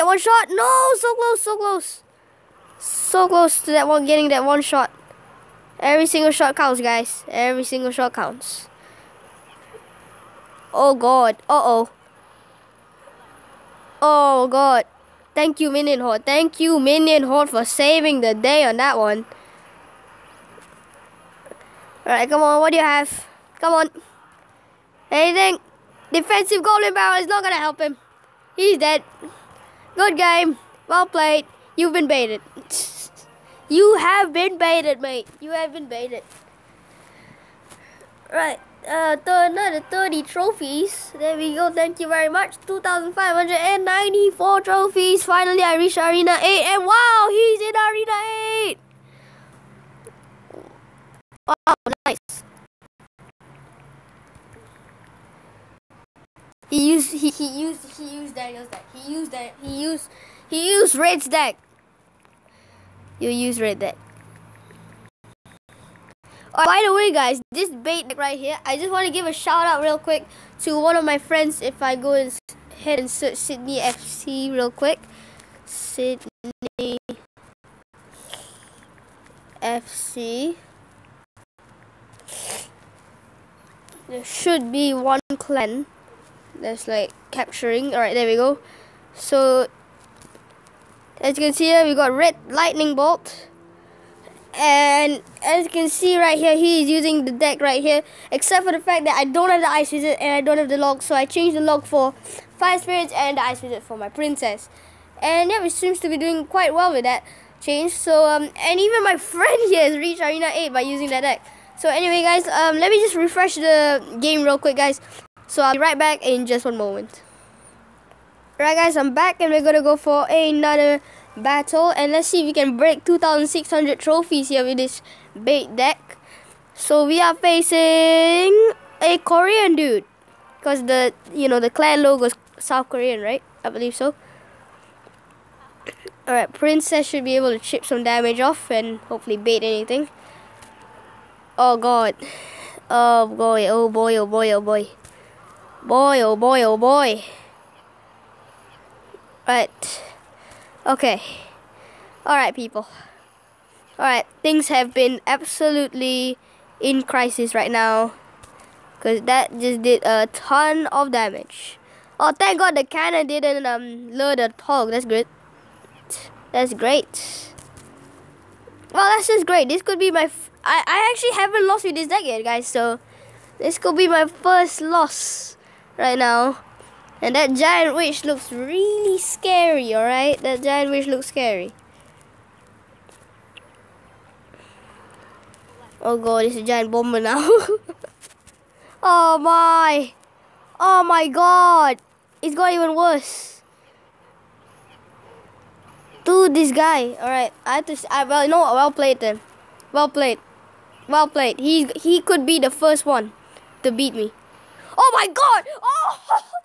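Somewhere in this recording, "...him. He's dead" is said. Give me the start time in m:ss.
0:27.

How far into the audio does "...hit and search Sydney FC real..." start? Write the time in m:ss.
1:12.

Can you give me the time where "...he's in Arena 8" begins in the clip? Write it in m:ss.
0:47.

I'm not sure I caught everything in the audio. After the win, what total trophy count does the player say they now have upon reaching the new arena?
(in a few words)
2594.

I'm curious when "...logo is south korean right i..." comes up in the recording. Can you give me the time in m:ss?
2:12.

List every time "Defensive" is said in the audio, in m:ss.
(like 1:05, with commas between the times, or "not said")
0:26.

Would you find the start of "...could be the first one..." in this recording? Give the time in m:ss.
3:22.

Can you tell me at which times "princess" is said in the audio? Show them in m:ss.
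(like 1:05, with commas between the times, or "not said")
1:44, 2:16.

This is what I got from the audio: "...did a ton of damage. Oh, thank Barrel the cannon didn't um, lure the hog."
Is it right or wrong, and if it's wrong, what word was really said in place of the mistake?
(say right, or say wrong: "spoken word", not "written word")
wrong: "God", not "Barrel".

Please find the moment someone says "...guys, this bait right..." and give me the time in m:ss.
1:07.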